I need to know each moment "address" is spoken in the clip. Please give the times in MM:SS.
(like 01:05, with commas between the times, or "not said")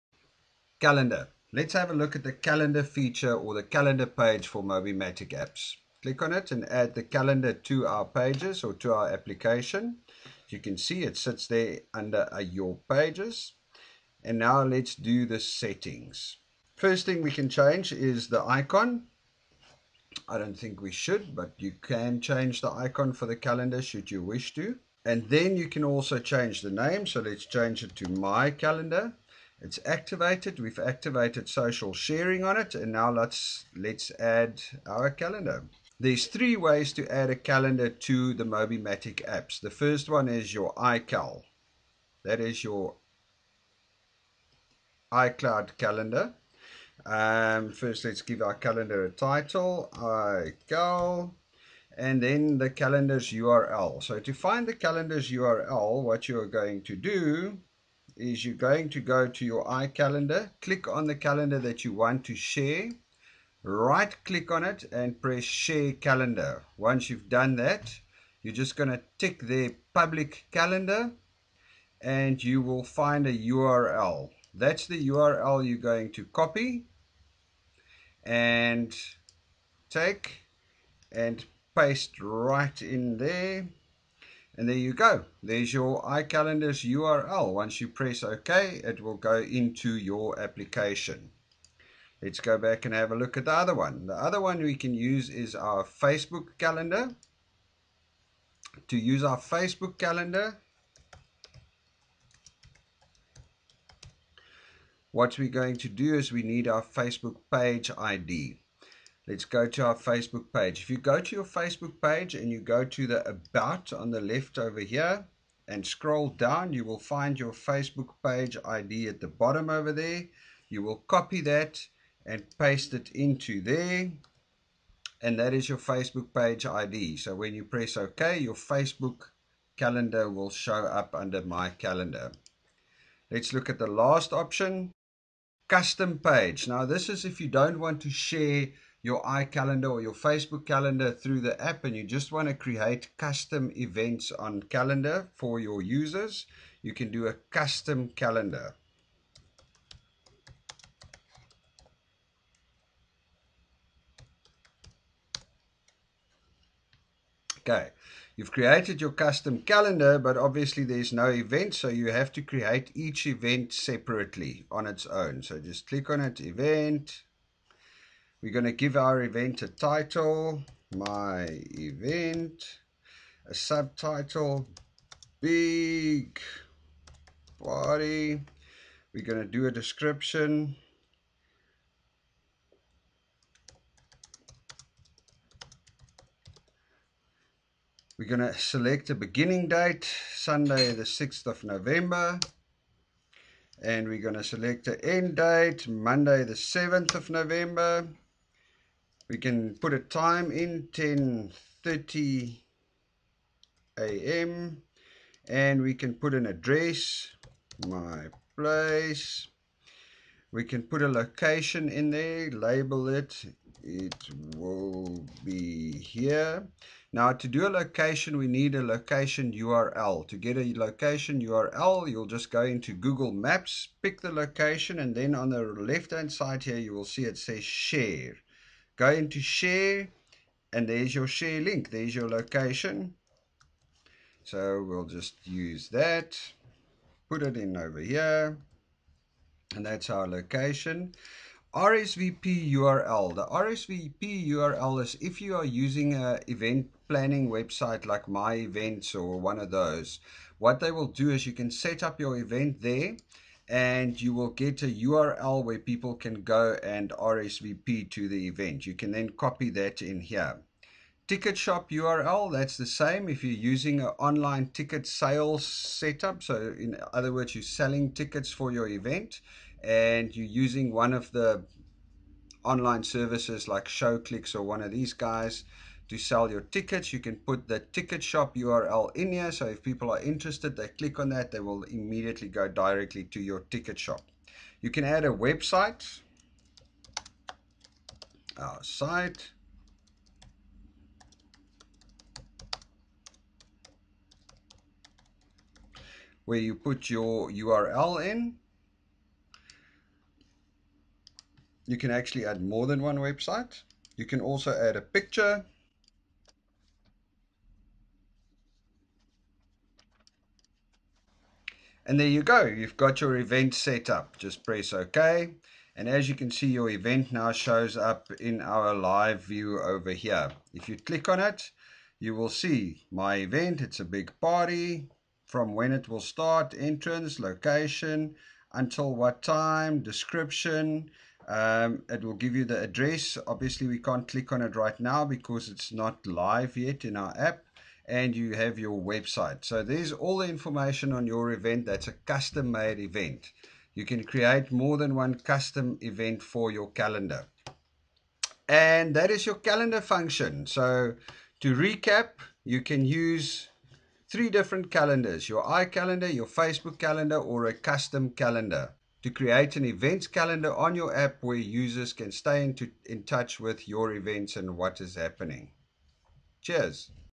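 03:26, 05:32.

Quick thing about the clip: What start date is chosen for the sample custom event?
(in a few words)
Sunday 6 November.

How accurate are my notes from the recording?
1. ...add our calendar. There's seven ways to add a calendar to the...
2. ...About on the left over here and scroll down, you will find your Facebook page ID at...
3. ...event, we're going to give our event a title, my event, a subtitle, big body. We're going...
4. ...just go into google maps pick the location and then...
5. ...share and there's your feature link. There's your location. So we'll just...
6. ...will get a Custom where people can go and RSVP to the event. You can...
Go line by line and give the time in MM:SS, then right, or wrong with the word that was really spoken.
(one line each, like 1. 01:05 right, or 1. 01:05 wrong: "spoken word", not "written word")
1. 00:34 wrong: "three", not "seven"
2. 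01:53 right
3. 02:46 right
4. 03:42 right
5. 03:49 wrong: "share", not "feature"
6. 04:14 wrong: "URL", not "Custom".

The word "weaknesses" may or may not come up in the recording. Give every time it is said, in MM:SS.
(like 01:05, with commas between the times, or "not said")
not said.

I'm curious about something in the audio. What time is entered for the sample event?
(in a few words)
10:30 a.m.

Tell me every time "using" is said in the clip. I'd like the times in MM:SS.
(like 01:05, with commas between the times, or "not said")
04:05, 04:23, 04:30.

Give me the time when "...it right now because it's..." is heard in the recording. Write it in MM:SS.
05:34.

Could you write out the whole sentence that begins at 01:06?
Once you've done that, you're just going to tick the public calendar and you will find a URL.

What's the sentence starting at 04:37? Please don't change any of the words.
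You can put the ticket shop URL in here.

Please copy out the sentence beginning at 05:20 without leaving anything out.
If you click on it, you will see my event.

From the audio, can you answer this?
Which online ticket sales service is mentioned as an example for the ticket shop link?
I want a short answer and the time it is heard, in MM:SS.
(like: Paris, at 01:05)
ShowClix, at 04:33.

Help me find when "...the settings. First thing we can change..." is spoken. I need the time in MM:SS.
00:15.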